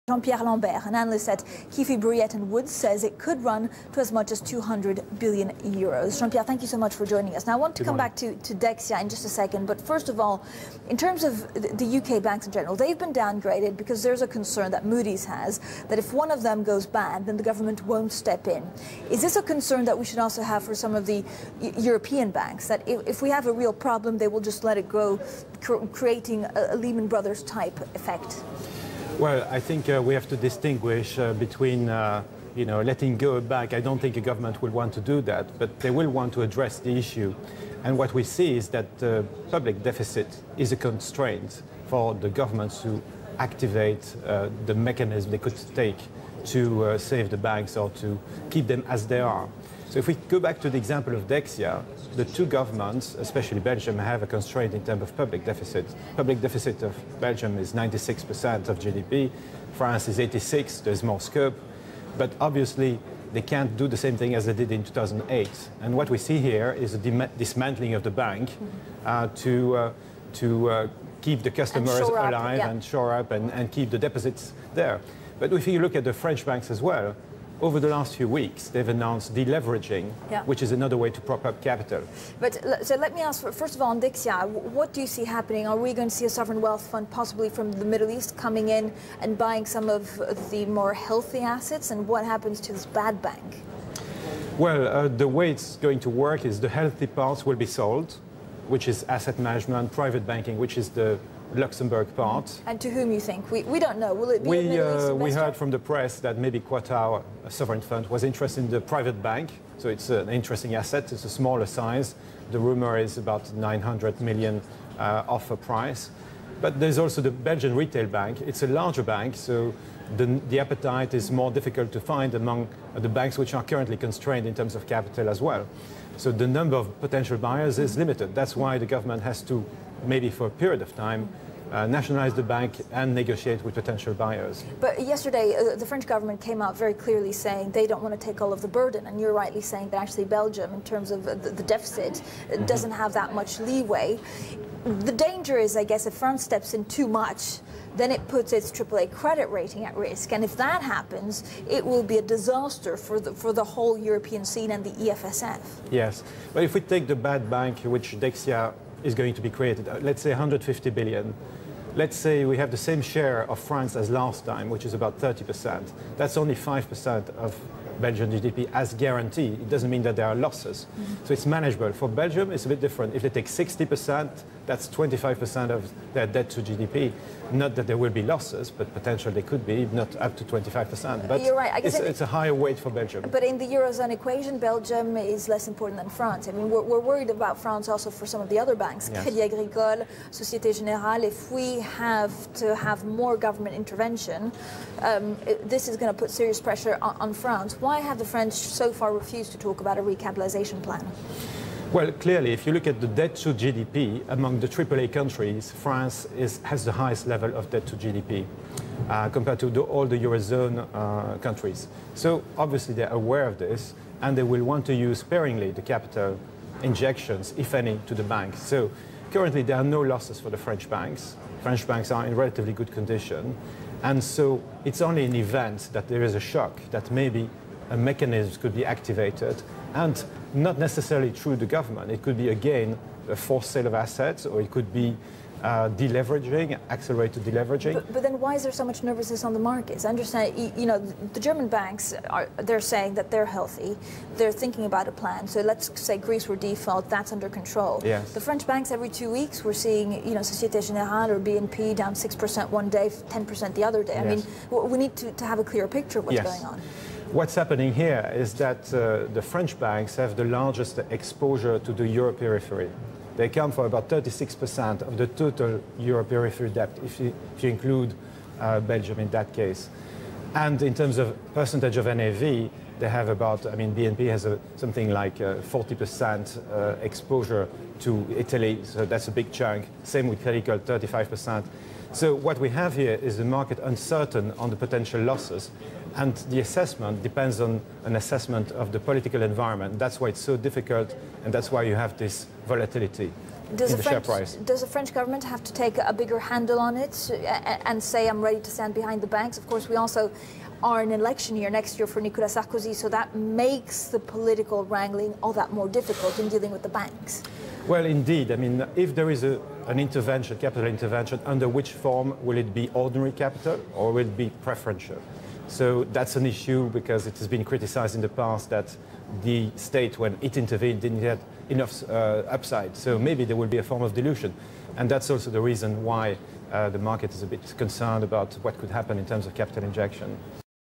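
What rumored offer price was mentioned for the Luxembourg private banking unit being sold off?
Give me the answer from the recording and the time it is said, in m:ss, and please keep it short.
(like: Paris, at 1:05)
900 million, at 1:53.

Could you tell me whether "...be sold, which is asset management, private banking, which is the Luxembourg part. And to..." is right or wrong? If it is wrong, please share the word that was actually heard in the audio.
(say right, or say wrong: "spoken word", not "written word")
right.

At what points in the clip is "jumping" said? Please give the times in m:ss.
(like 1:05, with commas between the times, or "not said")
not said.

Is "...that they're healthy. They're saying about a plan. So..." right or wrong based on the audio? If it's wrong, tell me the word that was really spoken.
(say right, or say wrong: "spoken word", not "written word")
wrong: "thinking", not "saying".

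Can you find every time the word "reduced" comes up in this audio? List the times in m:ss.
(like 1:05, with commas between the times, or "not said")
not said.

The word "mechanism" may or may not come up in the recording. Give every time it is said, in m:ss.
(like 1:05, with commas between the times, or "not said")
0:44, 3:47.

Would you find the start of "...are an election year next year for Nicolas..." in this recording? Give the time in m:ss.
5:00.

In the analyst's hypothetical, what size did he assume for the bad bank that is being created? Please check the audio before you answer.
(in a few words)
150 billion.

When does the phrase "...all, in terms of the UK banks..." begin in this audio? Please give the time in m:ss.
0:10.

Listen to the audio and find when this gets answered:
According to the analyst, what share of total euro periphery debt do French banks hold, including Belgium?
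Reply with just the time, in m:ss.
4:24.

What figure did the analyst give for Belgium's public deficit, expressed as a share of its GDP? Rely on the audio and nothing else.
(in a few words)
96%.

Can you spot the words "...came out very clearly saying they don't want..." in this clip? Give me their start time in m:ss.
2:16.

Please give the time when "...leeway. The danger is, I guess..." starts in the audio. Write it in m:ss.
2:23.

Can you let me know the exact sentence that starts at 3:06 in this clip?
I mean, we're, we're worried about France also for some of the other banks, yes.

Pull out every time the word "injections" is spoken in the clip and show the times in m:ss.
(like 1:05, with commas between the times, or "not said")
3:36, 5:29.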